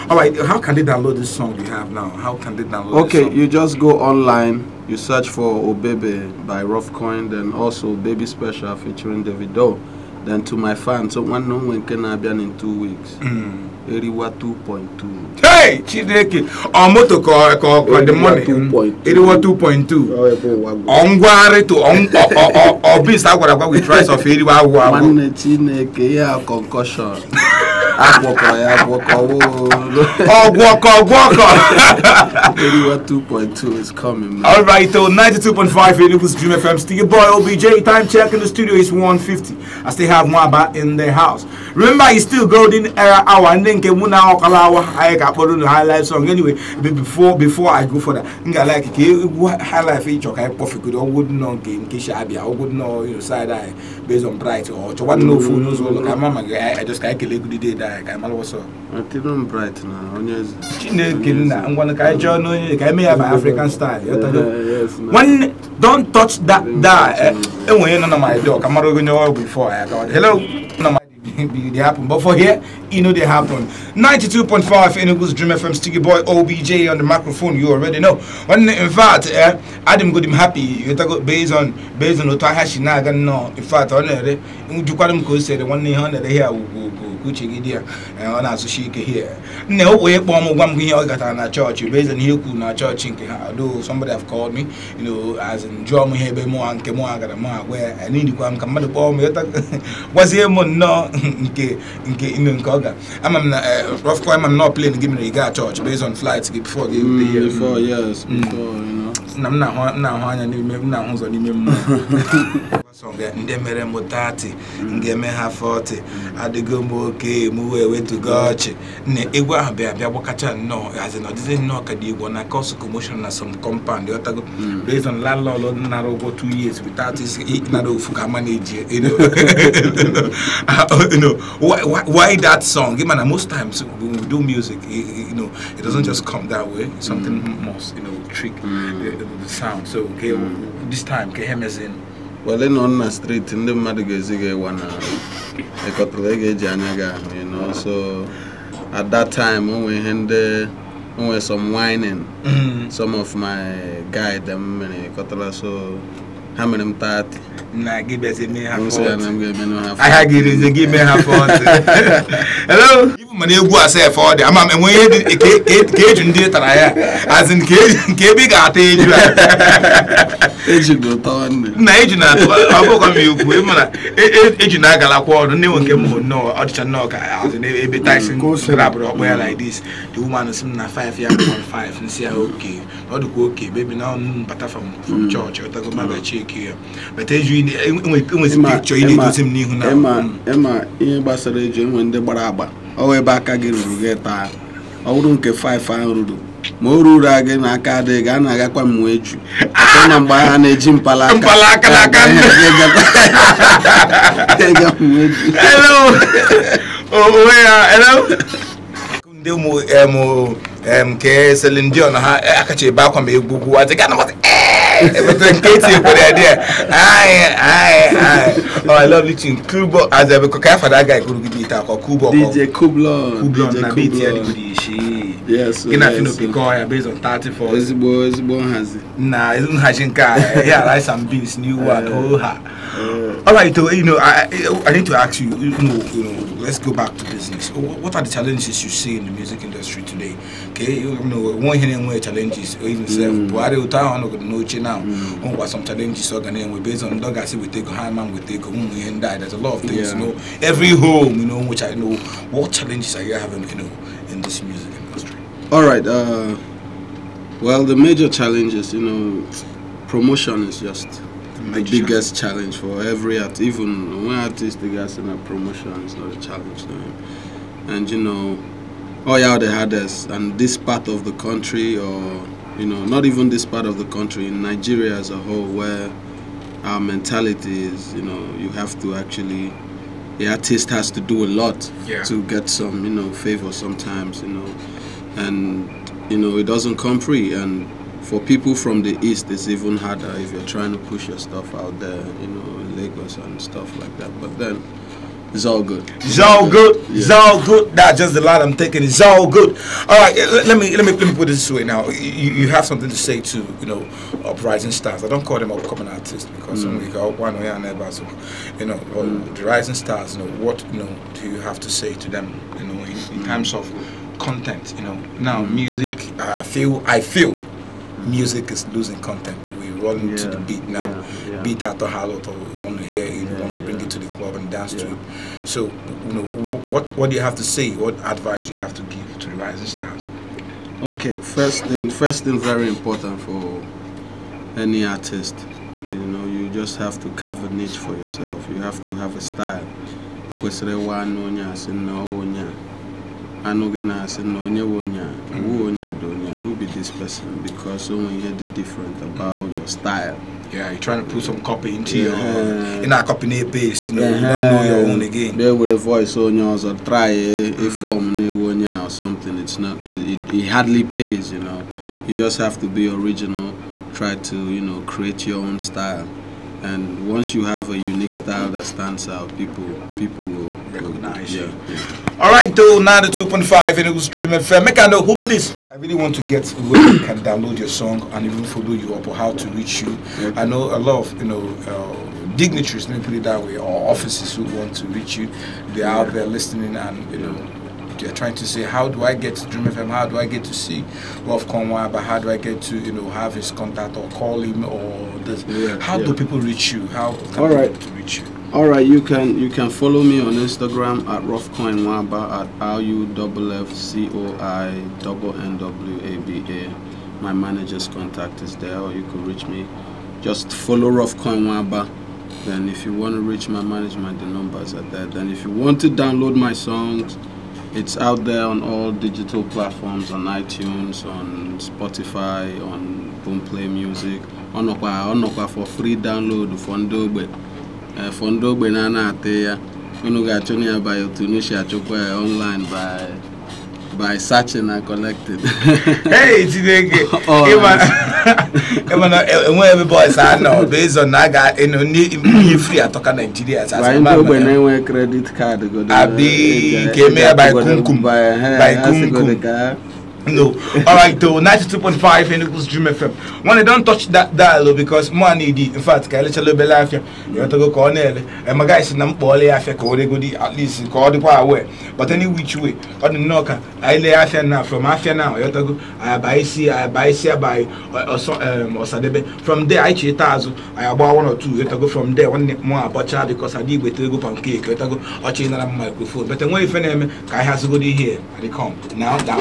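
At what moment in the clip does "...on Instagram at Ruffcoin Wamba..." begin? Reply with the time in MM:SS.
06:40.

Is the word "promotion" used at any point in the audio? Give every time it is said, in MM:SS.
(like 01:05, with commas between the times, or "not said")
04:20, 04:25.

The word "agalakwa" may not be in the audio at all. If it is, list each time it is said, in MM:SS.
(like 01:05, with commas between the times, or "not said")
02:54.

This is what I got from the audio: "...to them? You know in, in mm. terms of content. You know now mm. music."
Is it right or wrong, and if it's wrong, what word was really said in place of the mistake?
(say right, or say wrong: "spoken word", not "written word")
right.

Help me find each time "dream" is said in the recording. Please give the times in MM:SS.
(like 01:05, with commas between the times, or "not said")
00:36, 01:15, 06:14, 06:29, 07:32.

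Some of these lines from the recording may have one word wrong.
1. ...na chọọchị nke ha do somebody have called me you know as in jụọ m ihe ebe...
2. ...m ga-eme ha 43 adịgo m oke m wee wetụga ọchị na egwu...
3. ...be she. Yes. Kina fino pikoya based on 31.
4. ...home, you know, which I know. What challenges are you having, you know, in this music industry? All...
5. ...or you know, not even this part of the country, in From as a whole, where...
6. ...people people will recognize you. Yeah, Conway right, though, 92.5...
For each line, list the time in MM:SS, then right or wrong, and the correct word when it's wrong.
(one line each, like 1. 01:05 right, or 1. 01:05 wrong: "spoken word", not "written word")
1. 01:32 right
2. 01:54 wrong: "40", not "43"
3. 03:44 wrong: "34", not "31"
4. 04:10 right
5. 04:31 wrong: "Nigeria", not "From"
6. 06:09 wrong: "All", not "Conway".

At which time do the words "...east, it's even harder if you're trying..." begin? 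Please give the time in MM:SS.
04:49.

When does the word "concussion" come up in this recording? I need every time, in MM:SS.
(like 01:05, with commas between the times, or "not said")
00:26.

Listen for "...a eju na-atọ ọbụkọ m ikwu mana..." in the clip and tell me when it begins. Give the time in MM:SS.
02:49.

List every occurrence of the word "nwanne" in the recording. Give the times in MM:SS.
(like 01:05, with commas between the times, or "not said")
00:11, 00:24, 01:05.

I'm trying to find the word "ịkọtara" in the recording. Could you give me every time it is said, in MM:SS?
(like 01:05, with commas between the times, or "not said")
02:25, 02:35.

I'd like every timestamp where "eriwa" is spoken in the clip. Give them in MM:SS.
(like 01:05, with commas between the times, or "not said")
00:13, 00:19, 00:24.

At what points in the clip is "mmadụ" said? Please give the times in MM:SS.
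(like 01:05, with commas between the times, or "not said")
01:38, 02:23.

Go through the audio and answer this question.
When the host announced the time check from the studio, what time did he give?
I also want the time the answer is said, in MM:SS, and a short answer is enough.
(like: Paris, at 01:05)
1:50, at 00:38.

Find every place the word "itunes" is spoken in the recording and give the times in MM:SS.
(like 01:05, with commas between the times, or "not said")
07:00.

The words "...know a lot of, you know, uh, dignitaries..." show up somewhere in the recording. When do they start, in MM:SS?
06:20.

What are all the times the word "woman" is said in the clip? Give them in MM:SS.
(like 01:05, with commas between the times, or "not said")
03:00, 04:08.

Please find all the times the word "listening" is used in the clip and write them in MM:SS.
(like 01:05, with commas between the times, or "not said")
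03:39, 06:26.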